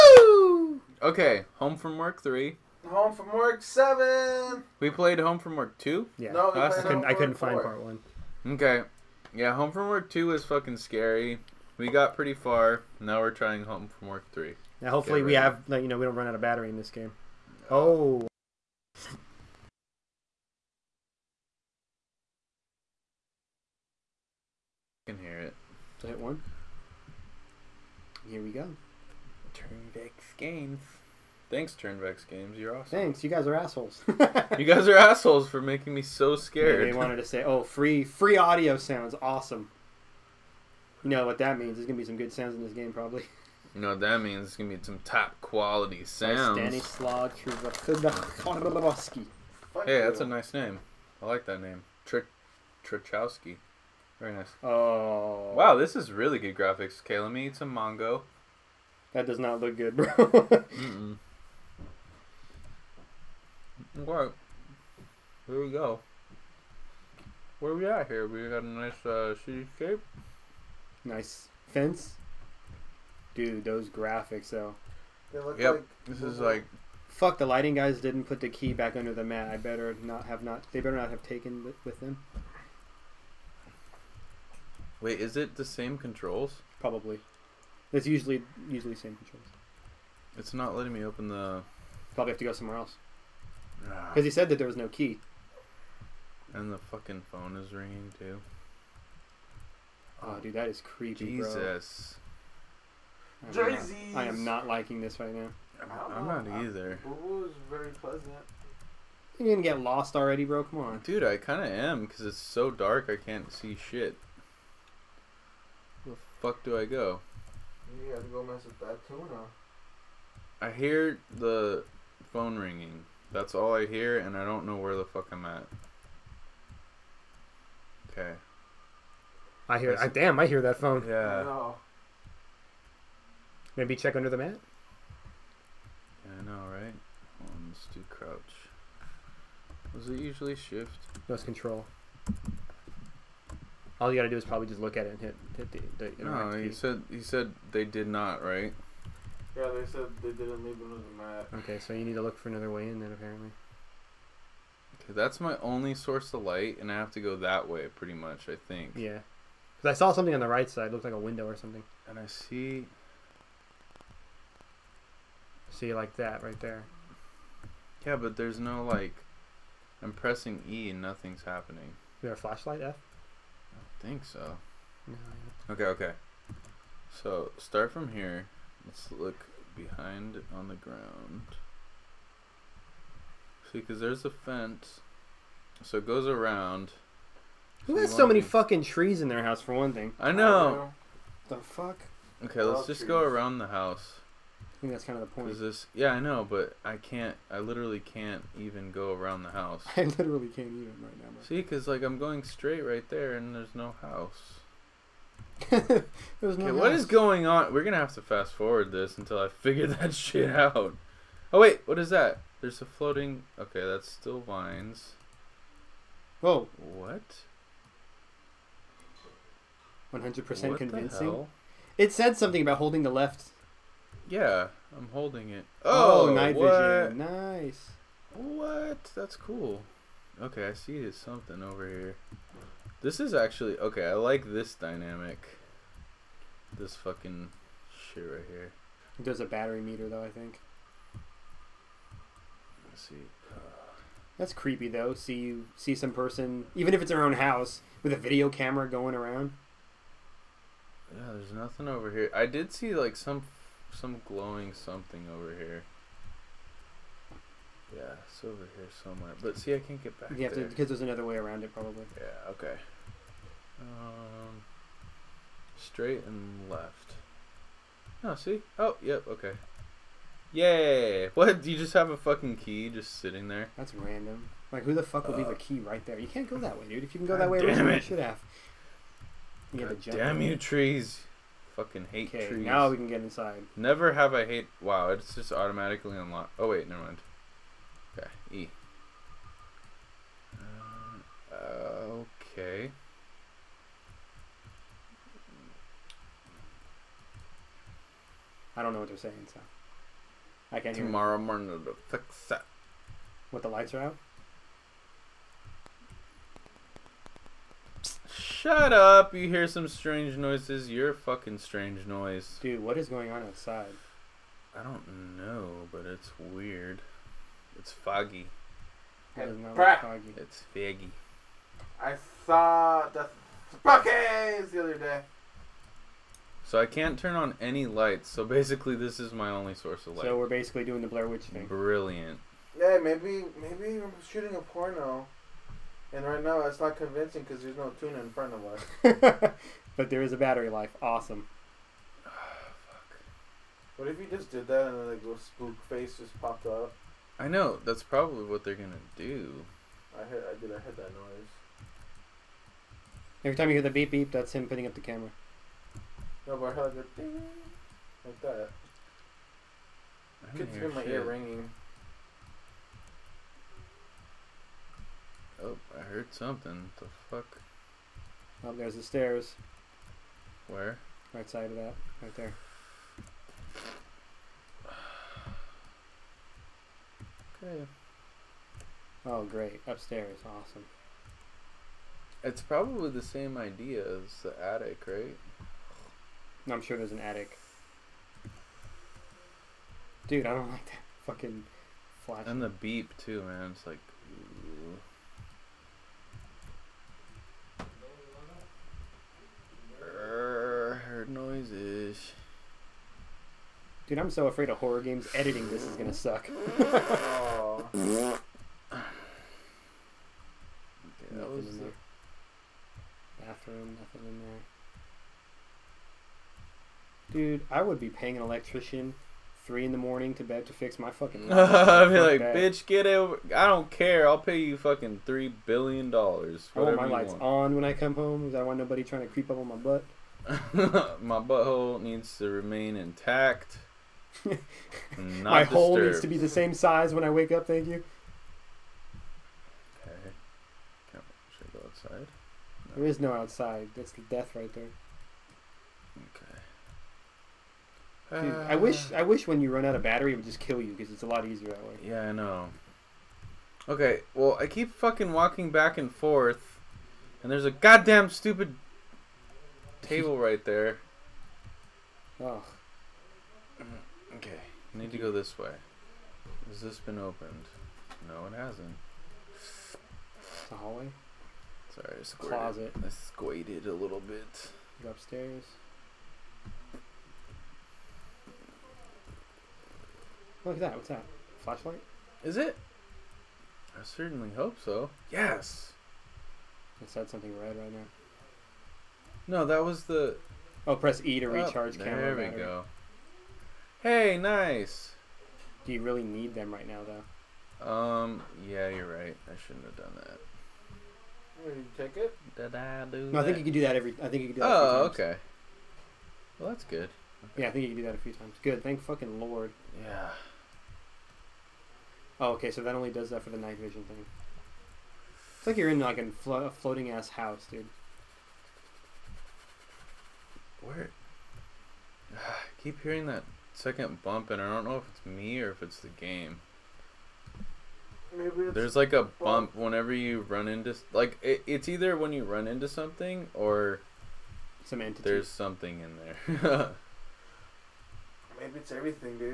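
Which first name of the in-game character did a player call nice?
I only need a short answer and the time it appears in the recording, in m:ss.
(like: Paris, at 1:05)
Stanislaw, at 0:46.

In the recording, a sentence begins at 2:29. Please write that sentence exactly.
Yeah, they said they didn't leave the map.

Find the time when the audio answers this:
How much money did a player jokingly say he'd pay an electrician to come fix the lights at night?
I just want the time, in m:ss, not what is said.
7:05.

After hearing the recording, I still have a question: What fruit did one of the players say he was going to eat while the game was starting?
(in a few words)
Mango.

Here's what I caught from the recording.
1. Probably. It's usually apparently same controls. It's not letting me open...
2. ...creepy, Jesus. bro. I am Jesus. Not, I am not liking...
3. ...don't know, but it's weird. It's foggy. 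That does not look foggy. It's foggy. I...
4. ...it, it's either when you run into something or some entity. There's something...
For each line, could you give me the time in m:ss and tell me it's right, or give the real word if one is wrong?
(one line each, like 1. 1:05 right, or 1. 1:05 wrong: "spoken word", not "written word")
1. 1:26 wrong: "usually", not "apparently"
2. 1:40 right
3. 5:14 right
4. 8:51 right.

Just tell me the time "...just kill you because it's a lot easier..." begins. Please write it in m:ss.
7:30.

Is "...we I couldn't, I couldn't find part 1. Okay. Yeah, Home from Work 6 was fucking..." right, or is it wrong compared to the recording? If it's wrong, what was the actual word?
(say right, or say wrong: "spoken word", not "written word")
wrong: "2", not "6".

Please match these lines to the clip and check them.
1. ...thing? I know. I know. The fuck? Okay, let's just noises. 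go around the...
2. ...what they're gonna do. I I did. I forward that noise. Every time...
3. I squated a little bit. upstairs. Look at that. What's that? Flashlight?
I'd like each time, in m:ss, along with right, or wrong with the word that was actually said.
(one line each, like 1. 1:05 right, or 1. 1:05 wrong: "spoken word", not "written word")
1. 3:09 wrong: "trees", not "noises"
2. 5:48 wrong: "heard", not "forward"
3. 7:53 right.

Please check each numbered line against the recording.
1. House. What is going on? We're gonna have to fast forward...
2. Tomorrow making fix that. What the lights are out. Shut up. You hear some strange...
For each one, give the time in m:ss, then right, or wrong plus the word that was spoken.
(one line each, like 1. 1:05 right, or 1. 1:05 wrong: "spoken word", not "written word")
1. 3:26 right
2. 5:00 wrong: "morning", not "making".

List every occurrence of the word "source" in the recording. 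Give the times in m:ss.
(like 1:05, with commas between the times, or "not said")
2:35, 5:29.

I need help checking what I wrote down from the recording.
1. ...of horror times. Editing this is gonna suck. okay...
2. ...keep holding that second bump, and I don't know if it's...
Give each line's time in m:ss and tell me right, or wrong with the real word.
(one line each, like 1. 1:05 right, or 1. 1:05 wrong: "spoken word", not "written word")
1. 6:44 wrong: "games", not "times"
2. 8:42 wrong: "hearing", not "holding".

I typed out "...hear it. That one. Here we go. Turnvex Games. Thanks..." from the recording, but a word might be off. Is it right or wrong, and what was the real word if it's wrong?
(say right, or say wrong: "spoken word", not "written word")
right.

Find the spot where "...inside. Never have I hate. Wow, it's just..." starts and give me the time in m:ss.
4:43.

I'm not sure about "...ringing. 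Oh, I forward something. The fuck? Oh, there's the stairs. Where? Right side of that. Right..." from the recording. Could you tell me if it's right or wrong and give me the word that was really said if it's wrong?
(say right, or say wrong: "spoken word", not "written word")
wrong: "heard", not "forward".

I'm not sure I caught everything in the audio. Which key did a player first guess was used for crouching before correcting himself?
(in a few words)
Shift.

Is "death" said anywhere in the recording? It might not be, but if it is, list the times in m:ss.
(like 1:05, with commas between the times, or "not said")
7:24.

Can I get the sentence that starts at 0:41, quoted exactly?
There's gonna be some good sounds in this game, probably.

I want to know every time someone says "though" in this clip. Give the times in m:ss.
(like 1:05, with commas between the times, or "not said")
1:14, 4:00, 4:04, 8:17.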